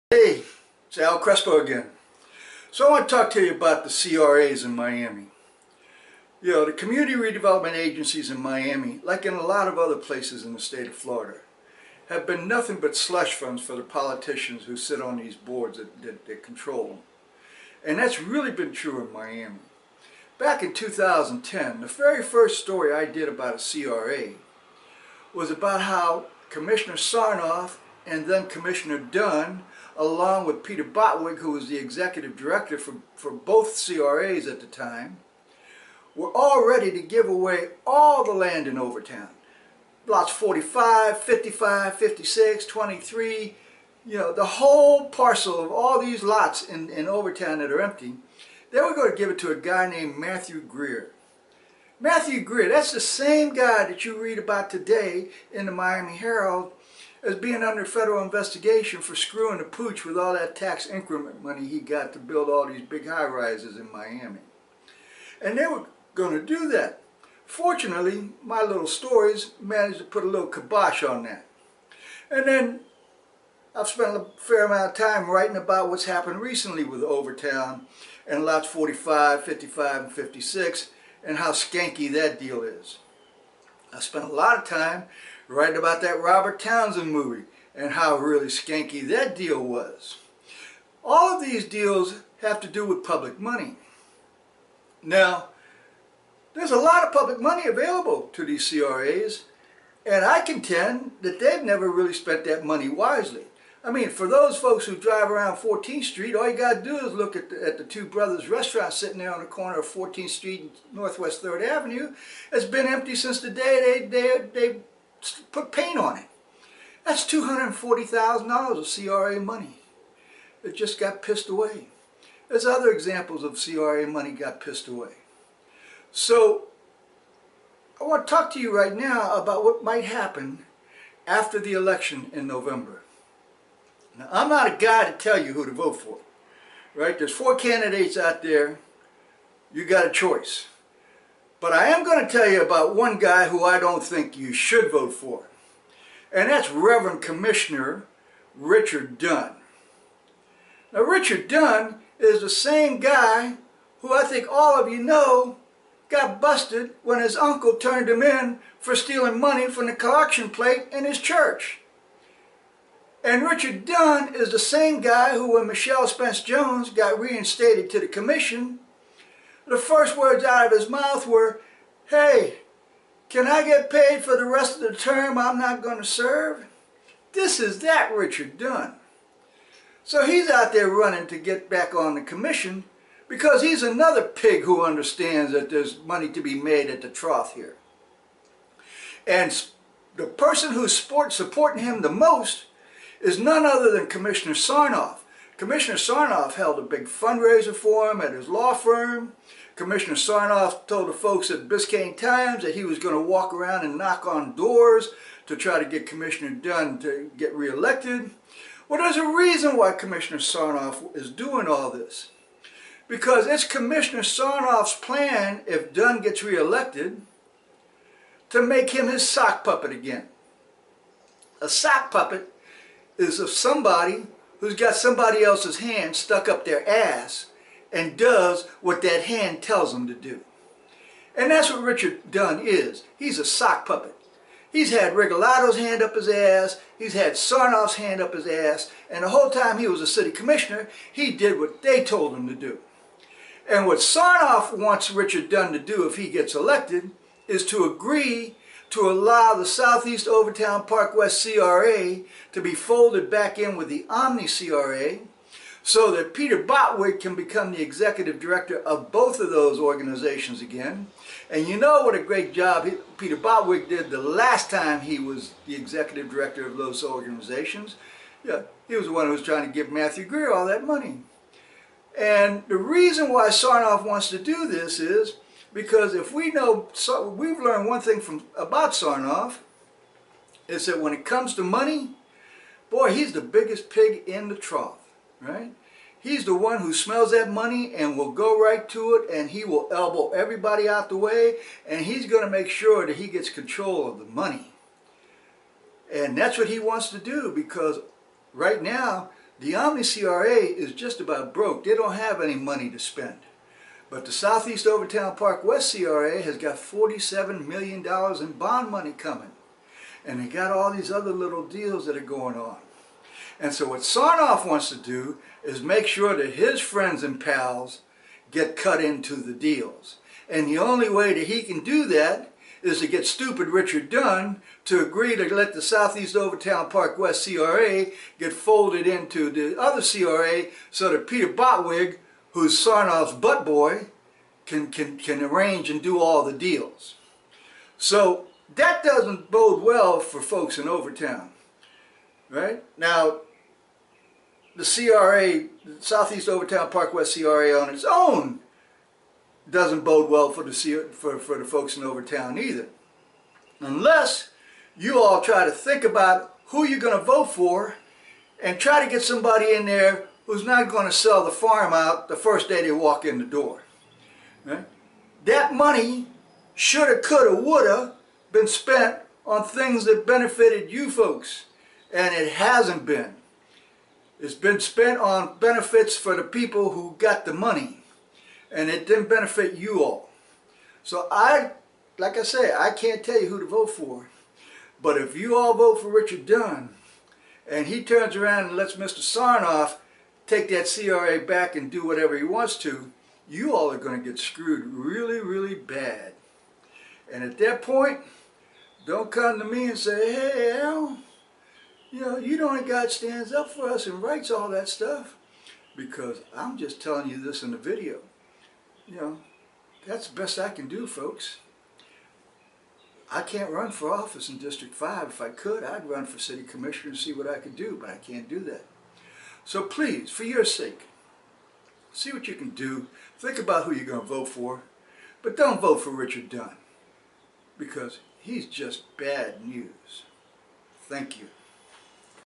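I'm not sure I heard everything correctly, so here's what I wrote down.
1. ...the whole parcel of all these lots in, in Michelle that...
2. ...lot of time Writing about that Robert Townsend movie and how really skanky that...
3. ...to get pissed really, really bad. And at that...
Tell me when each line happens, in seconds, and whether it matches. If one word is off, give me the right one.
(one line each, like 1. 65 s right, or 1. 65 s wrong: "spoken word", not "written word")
1. 44 s wrong: "Overtown", not "Michelle"
2. 84 s right
3. 394 s wrong: "screwed", not "pissed".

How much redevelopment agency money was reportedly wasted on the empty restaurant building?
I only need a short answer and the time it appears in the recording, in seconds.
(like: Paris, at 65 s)
$240,000, at 117 s.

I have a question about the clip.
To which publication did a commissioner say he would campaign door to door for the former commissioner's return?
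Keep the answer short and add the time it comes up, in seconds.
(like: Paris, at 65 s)
Biscayne Times, at 201 s.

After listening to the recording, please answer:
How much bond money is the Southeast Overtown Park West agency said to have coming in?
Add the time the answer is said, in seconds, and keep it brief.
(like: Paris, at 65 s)
$47 million, at 306 s.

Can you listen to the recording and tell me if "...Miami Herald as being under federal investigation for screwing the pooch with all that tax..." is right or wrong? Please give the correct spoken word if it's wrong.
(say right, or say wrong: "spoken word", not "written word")
right.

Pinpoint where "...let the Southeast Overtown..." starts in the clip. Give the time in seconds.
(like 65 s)
325 s.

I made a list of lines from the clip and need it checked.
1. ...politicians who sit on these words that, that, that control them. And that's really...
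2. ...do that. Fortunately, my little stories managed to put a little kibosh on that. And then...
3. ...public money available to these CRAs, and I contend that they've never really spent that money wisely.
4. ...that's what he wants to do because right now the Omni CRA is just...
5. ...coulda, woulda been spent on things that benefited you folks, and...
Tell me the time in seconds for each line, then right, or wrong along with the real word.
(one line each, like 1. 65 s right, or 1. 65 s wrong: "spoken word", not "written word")
1. 13 s wrong: "boards", not "words"
2. 66 s right
3. 97 s right
4. 296 s right
5. 367 s right.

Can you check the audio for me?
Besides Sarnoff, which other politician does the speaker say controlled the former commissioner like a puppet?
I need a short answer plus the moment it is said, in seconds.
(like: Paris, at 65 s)
Regalado, at 235 s.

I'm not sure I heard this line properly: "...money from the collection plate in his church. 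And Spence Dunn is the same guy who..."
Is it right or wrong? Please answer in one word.
wrong.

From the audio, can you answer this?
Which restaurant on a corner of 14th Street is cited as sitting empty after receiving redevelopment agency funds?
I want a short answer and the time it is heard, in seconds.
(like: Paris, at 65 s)
Two Brothers, at 107 s.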